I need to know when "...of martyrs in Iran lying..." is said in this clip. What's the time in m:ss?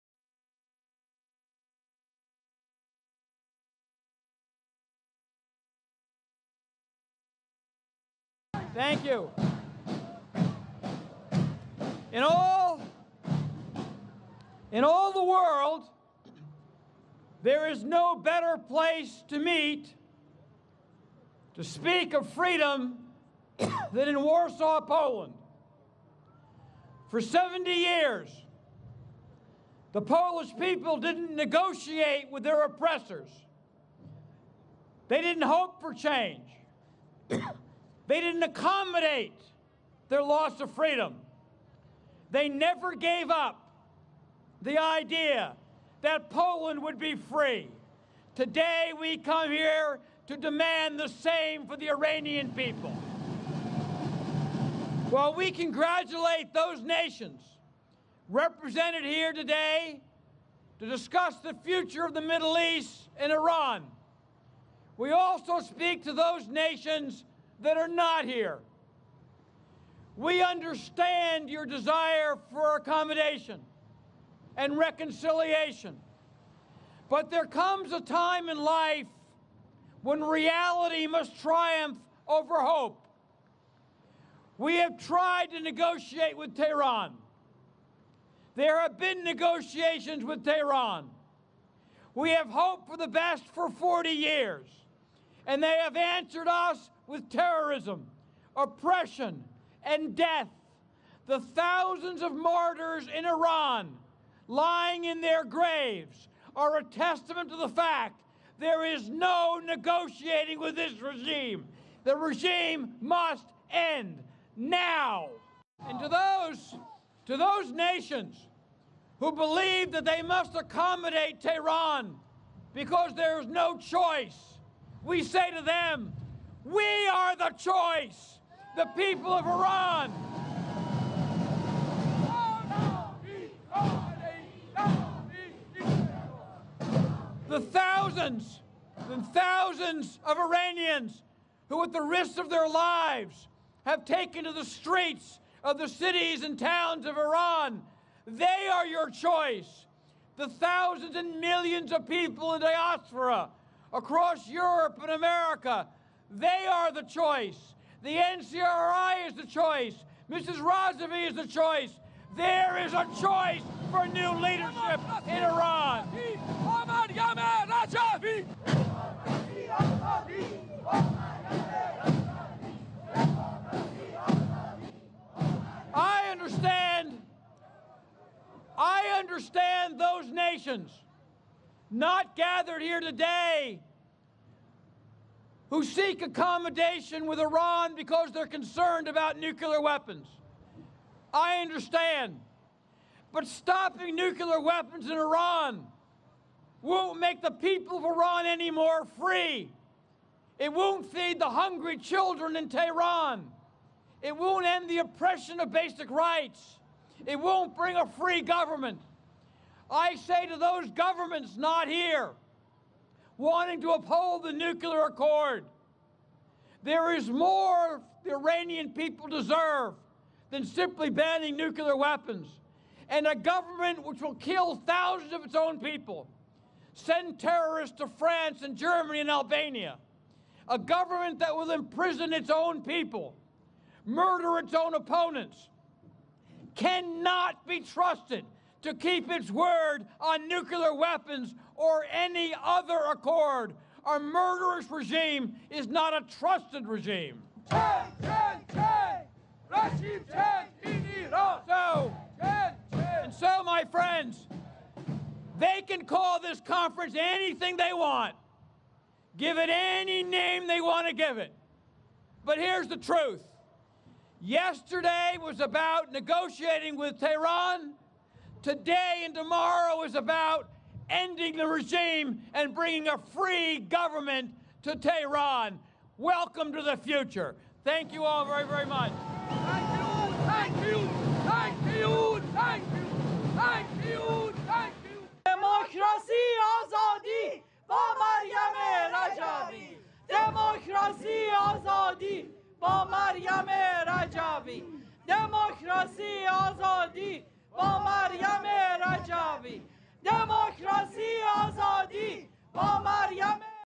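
1:42.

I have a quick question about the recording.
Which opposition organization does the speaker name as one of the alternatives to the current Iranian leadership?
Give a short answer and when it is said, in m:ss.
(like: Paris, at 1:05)
NCRI, at 2:38.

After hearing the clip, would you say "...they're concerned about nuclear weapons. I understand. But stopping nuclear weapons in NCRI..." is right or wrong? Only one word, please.
wrong.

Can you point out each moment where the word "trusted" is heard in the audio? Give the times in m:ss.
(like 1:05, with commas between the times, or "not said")
3:57, 4:06.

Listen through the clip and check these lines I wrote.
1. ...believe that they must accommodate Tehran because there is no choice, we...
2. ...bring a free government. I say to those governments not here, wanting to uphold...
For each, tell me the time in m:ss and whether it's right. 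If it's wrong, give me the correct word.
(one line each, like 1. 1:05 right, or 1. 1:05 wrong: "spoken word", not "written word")
1. 1:59 right
2. 3:27 right.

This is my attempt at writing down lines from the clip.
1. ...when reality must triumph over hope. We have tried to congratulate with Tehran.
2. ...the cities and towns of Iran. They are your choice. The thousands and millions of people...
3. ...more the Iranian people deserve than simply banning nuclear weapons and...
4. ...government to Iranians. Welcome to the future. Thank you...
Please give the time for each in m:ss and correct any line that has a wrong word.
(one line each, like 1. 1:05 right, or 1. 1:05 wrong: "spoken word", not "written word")
1. 1:20 wrong: "negotiate", not "congratulate"
2. 2:25 right
3. 3:37 right
4. 4:33 wrong: "Tehran", not "Iranians".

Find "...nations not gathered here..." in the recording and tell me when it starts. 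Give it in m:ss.
3:00.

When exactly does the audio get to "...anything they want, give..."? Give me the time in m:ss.
4:17.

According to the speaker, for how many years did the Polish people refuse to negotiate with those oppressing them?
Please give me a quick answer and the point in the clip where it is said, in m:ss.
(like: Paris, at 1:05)
70, at 0:27.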